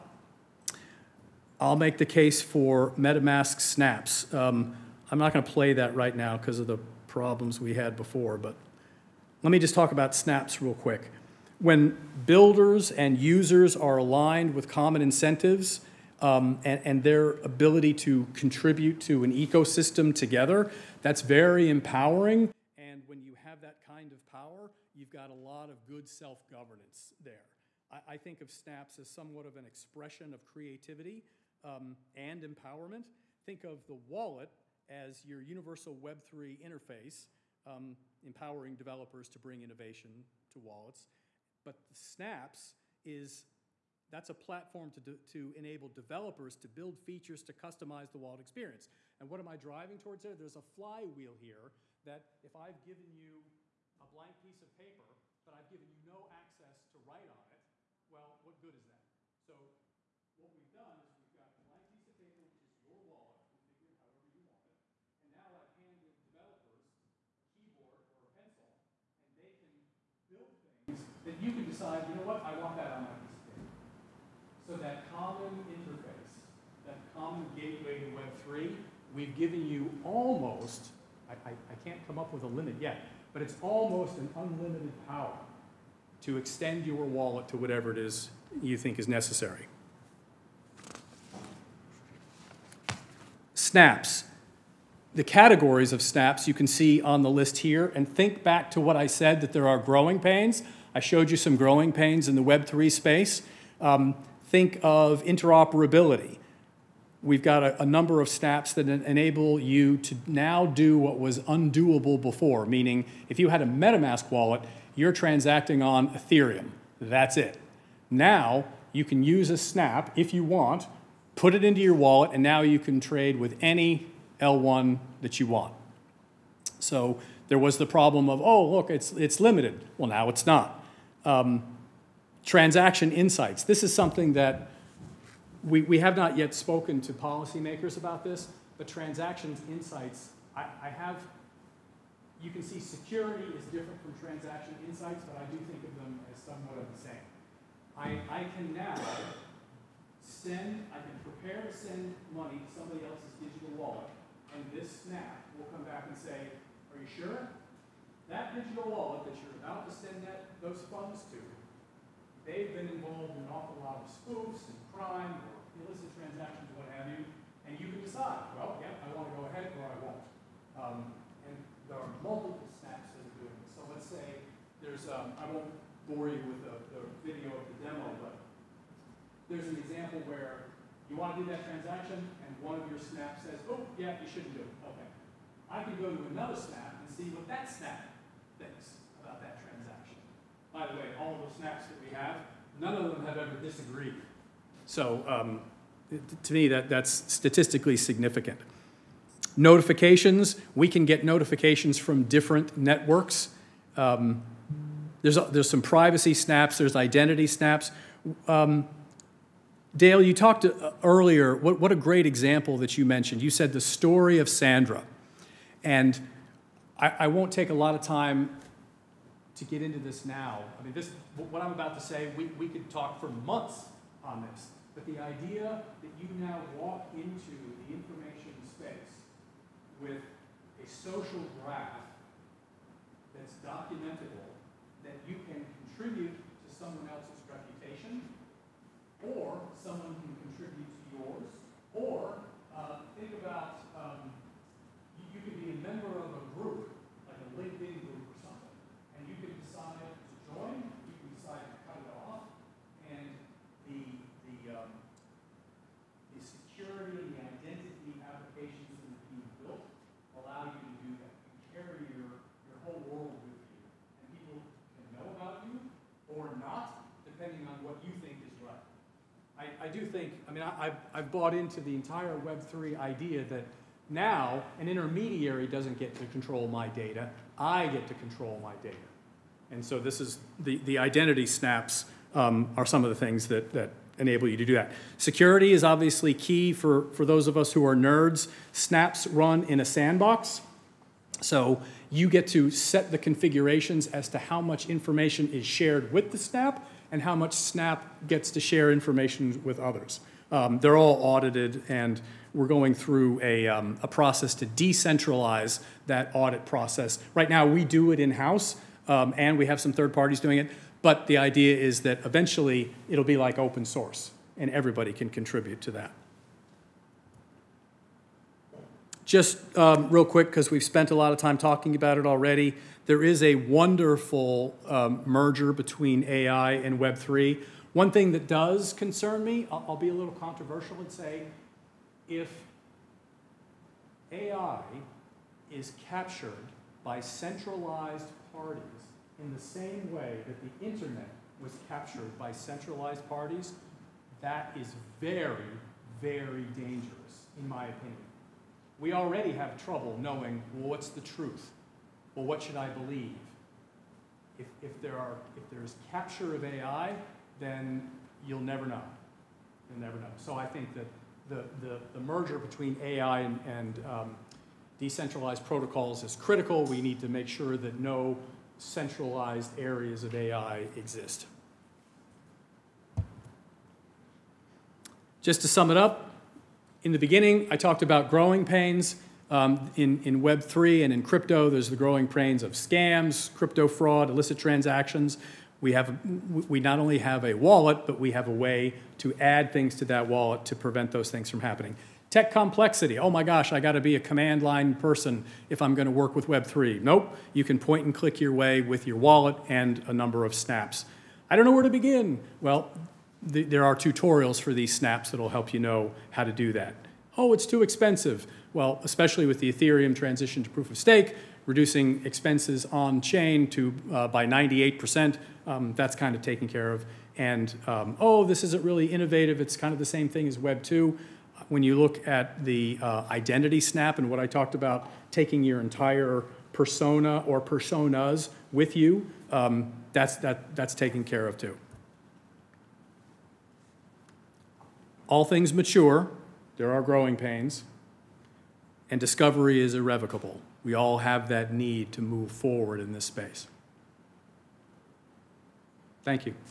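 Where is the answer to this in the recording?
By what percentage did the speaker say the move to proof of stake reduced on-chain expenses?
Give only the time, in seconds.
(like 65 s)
414 s.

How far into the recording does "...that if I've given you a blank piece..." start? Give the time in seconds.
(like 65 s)
52 s.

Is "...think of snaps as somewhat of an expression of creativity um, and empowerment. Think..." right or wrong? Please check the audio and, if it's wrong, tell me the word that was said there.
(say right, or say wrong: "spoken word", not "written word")
right.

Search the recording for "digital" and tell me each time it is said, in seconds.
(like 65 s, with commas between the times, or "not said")
153 s, 158 s.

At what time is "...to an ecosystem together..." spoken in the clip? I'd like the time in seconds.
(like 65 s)
19 s.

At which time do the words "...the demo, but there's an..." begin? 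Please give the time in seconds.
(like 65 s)
177 s.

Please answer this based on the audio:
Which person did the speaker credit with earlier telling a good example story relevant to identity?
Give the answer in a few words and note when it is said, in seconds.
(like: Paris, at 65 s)
Dale, at 209 s.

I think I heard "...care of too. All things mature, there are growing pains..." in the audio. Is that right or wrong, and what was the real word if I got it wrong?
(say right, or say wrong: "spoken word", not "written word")
right.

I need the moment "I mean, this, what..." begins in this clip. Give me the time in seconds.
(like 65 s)
220 s.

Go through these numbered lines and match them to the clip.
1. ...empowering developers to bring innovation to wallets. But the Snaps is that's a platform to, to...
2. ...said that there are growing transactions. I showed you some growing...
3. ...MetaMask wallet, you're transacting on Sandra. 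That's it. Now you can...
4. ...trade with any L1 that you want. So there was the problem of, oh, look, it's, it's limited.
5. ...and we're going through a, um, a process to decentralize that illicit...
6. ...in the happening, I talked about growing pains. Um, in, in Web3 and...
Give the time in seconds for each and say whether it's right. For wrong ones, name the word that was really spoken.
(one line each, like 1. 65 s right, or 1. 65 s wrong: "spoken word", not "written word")
1. 38 s right
2. 99 s wrong: "pains", not "transactions"
3. 113 s wrong: "Ethereum", not "Sandra"
4. 123 s right
5. 301 s wrong: "audit", not "illicit"
6. 377 s wrong: "beginning", not "happening".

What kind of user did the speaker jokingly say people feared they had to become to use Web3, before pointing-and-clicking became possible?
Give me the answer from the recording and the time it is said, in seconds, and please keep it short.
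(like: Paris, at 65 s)
command line person, at 394 s.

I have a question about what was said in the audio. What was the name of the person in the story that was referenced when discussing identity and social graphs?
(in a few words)
Sandra.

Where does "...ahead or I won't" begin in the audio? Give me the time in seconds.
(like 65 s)
169 s.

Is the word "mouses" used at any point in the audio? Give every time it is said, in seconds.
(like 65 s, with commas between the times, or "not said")
not said.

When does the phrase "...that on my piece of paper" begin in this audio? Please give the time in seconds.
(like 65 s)
72 s.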